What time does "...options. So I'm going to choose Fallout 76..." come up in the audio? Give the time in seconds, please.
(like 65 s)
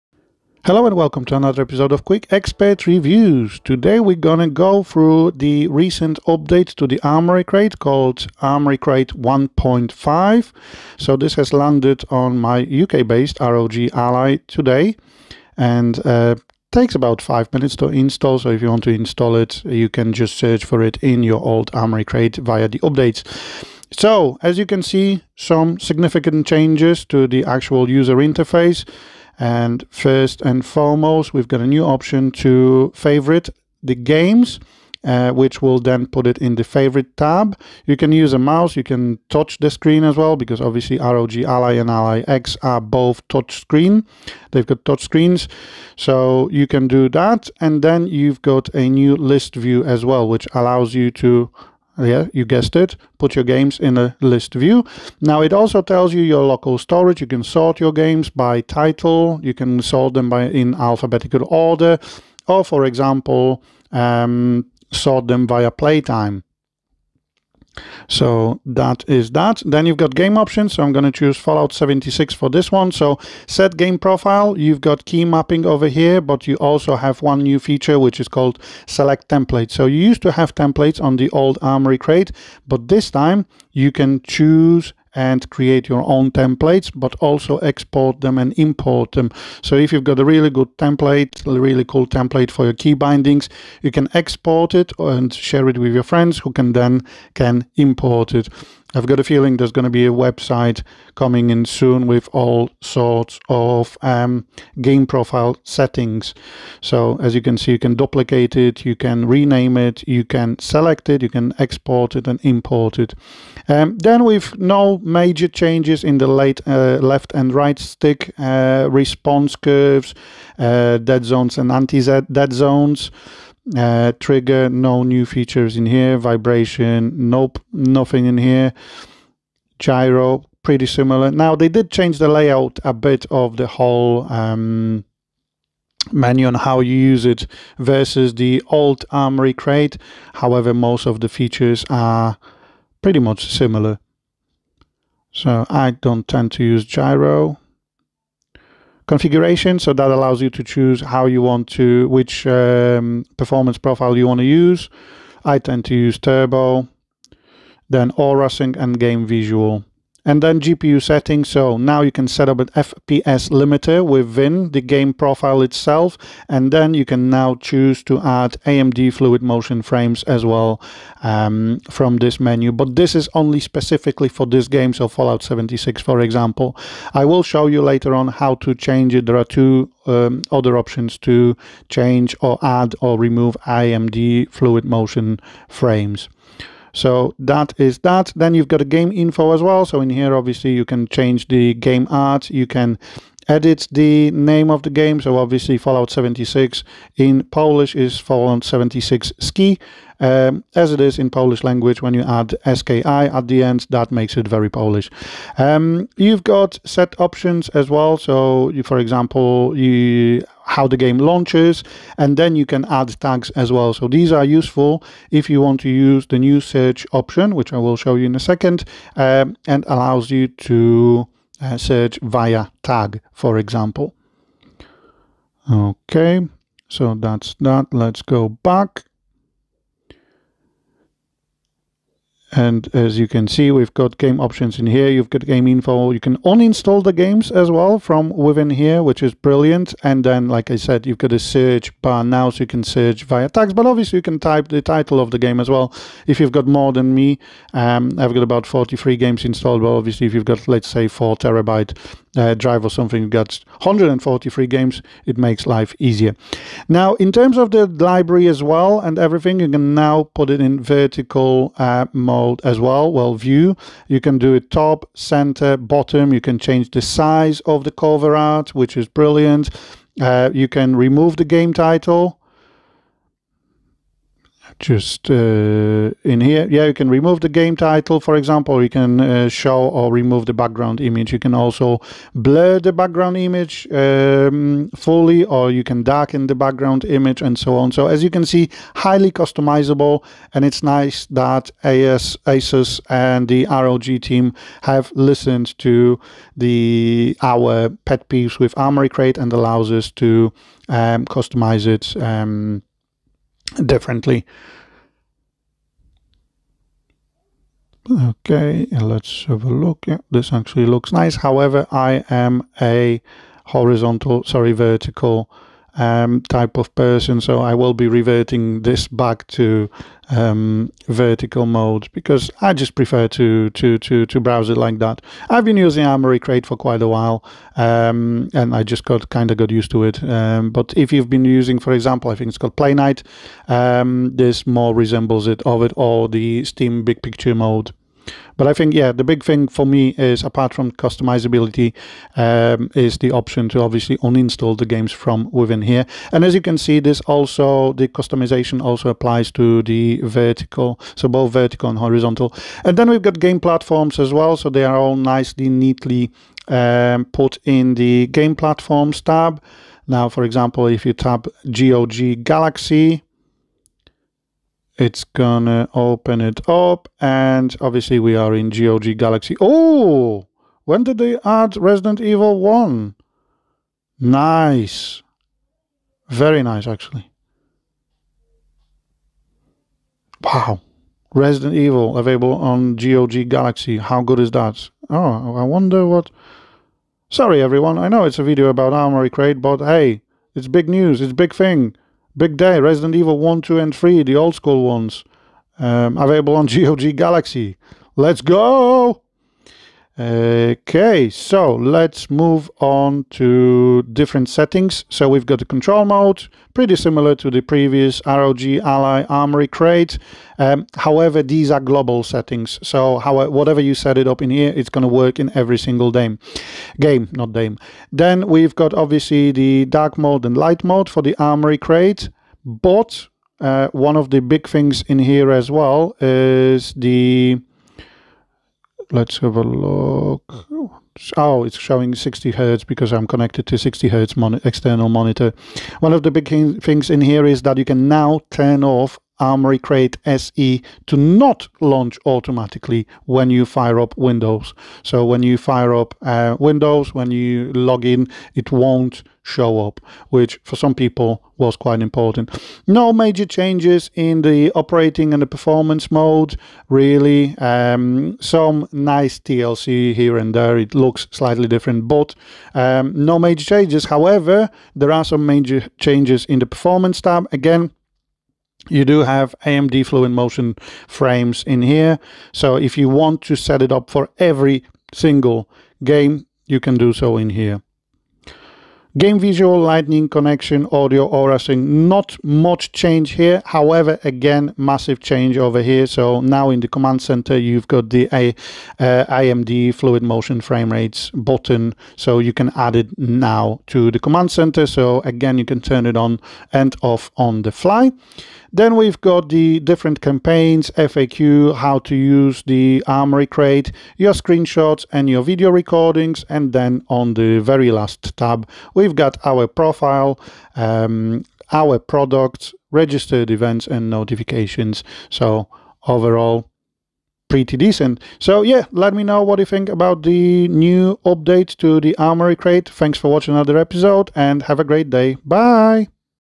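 70 s.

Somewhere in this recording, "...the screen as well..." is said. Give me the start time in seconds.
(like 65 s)
39 s.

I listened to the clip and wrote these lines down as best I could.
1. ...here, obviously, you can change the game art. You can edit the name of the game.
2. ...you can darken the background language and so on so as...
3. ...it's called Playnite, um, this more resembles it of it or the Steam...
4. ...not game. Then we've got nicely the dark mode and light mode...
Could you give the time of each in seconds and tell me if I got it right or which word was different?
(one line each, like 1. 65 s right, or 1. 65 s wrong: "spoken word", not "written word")
1. 190 s right
2. 285 s wrong: "image", not "language"
3. 332 s right
4. 417 s wrong: "obviously", not "nicely".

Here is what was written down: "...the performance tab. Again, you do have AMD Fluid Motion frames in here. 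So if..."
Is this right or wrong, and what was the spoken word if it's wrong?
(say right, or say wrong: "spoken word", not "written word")
right.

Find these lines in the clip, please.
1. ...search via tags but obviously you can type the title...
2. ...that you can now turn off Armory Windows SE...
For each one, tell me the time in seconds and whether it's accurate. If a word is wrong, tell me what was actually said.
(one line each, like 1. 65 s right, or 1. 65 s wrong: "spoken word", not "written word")
1. 242 s right
2. 437 s wrong: "Crate", not "Windows".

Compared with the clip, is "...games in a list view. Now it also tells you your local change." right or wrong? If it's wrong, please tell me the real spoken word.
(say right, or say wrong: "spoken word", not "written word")
wrong: "storage", not "change".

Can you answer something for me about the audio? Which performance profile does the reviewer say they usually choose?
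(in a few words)
Turbo.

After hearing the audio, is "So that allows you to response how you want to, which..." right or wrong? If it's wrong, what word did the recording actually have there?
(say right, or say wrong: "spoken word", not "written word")
wrong: "choose", not "response".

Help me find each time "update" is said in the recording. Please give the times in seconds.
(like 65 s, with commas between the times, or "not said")
6 s, 22 s, 521 s.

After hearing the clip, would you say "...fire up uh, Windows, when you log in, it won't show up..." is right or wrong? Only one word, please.
right.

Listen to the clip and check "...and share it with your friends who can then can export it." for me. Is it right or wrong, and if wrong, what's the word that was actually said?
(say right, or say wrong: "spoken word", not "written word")
wrong: "import", not "export".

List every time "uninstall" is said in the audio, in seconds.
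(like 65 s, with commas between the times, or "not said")
236 s, 344 s.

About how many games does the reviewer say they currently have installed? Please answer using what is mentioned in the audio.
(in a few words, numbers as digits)
43.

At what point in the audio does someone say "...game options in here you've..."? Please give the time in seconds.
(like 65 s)
234 s.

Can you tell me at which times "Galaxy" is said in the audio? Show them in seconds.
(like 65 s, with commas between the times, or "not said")
362 s, 369 s, 383 s, 397 s.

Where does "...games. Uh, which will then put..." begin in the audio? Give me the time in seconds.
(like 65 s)
33 s.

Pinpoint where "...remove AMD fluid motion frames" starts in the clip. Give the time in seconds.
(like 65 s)
183 s.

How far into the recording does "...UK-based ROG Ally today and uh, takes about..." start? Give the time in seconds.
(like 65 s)
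12 s.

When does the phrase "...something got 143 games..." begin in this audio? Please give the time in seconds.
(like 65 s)
252 s.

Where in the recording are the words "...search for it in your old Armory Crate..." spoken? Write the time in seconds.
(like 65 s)
20 s.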